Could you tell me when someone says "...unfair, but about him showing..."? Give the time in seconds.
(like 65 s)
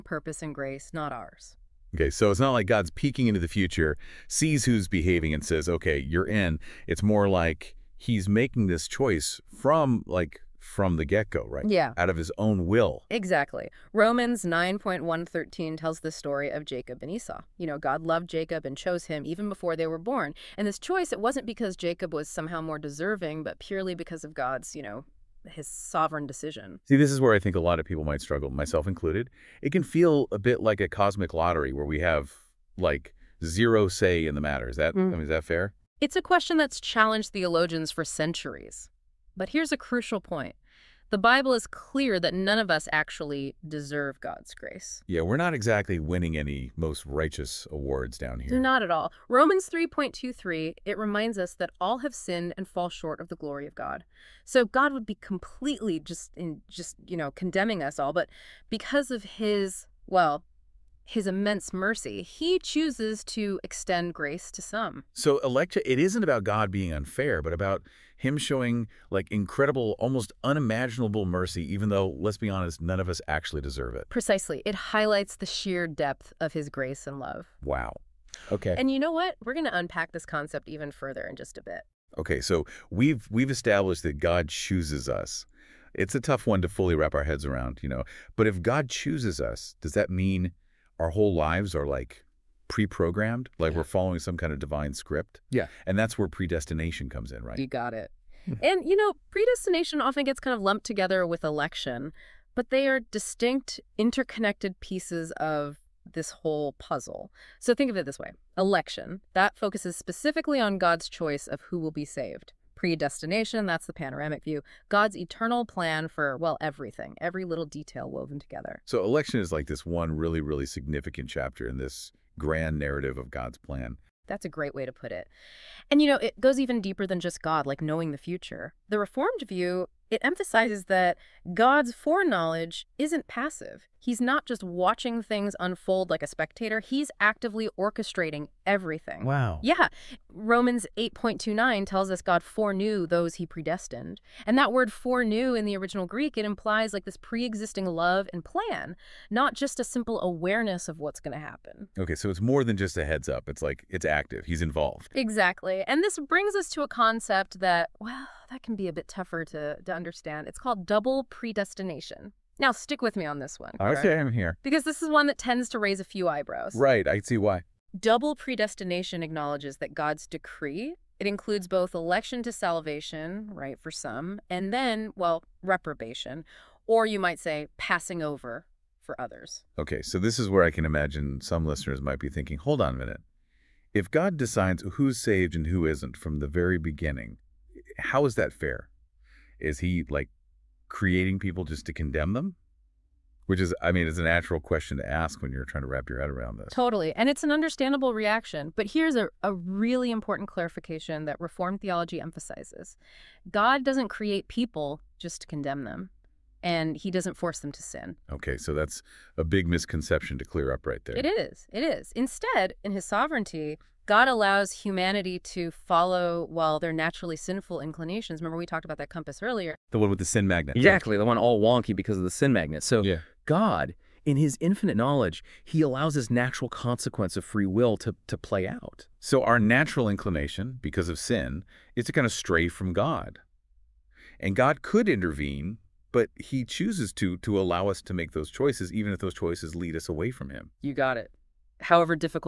66 s.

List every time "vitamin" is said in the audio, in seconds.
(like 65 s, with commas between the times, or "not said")
not said.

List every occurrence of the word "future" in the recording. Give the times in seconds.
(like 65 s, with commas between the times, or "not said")
3 s, 128 s.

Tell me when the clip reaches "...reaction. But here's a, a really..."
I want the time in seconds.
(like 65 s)
198 s.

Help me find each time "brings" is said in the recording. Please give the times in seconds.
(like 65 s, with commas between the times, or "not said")
156 s.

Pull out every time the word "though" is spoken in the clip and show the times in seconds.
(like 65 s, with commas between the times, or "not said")
71 s.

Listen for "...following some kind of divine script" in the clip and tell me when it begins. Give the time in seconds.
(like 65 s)
93 s.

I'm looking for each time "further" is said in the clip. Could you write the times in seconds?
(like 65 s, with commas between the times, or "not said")
80 s.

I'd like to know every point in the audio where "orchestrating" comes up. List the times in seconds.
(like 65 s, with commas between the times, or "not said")
137 s.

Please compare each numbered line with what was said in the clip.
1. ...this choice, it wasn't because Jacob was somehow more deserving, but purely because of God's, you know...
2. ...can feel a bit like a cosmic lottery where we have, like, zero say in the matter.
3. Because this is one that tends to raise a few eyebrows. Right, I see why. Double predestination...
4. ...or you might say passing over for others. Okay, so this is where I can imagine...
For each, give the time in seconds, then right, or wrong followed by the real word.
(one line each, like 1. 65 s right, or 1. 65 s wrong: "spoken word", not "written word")
1. 20 s right
2. 29 s right
3. 164 s right
4. 176 s right.